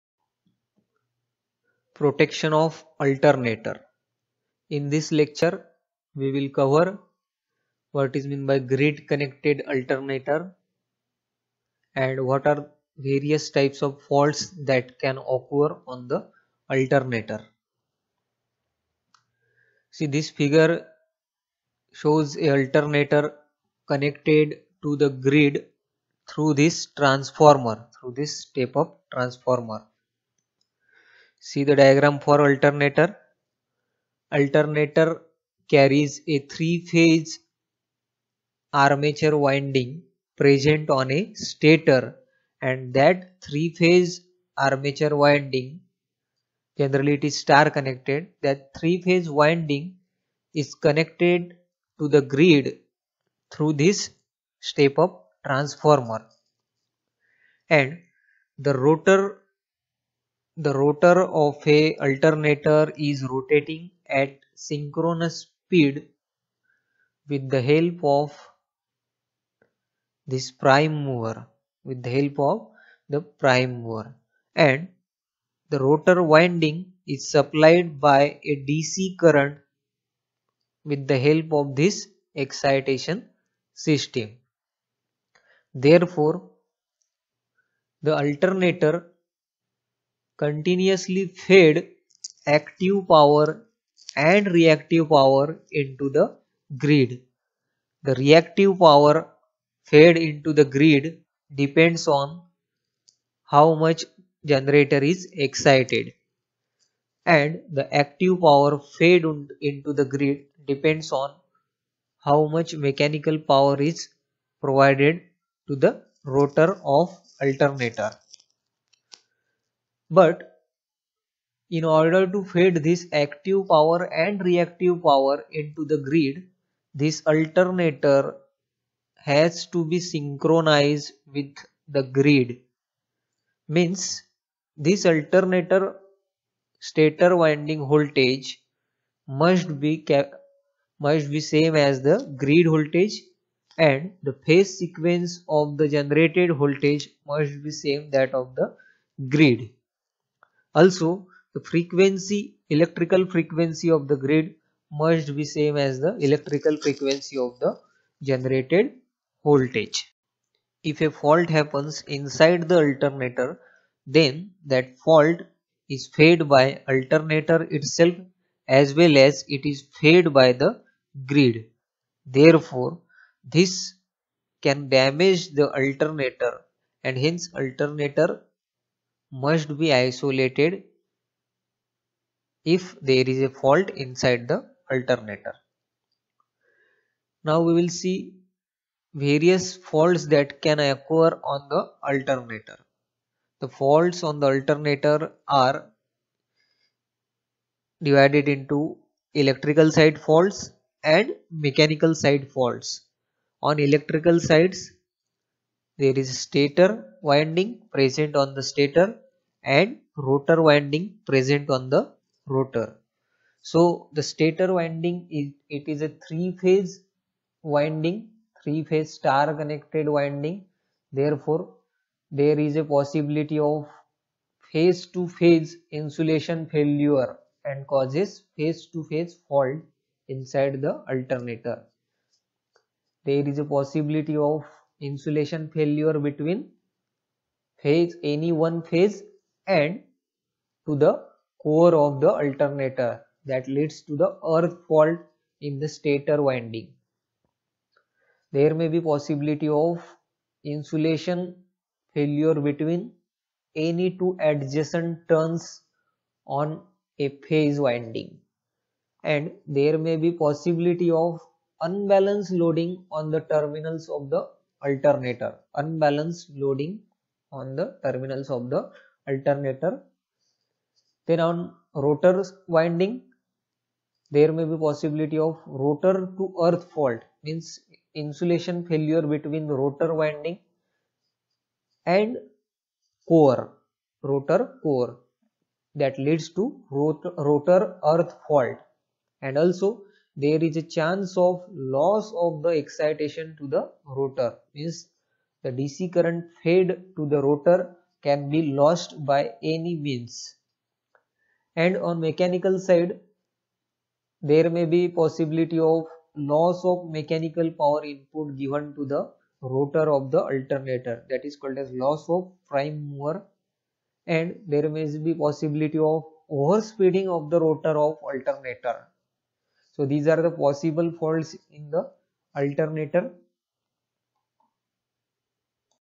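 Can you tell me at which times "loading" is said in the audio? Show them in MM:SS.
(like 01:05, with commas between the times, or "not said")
04:22, 04:26.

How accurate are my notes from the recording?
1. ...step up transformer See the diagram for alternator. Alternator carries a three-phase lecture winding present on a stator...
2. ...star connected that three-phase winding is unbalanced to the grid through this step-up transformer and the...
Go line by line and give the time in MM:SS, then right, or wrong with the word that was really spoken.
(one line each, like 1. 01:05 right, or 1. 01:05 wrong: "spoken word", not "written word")
1. 00:28 wrong: "armature", not "lecture"
2. 00:47 wrong: "connected", not "unbalanced".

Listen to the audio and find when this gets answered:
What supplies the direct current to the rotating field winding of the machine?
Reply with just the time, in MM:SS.
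01:22.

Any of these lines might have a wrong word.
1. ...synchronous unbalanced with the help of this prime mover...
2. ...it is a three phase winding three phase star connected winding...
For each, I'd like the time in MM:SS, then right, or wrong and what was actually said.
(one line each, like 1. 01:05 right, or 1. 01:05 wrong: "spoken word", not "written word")
1. 01:04 wrong: "speed", not "unbalanced"
2. 03:35 right.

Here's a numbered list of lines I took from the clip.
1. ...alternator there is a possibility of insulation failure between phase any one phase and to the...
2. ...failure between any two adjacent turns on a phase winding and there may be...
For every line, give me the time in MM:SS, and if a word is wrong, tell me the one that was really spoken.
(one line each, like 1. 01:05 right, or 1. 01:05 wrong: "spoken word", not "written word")
1. 03:51 right
2. 04:12 right.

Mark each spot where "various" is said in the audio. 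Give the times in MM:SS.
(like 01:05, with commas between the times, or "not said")
00:12, 03:09.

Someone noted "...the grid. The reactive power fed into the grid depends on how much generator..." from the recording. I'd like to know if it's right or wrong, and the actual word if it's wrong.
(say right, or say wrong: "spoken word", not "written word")
right.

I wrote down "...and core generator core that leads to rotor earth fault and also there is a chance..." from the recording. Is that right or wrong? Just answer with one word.
wrong.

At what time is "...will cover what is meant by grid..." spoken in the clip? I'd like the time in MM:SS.
00:06.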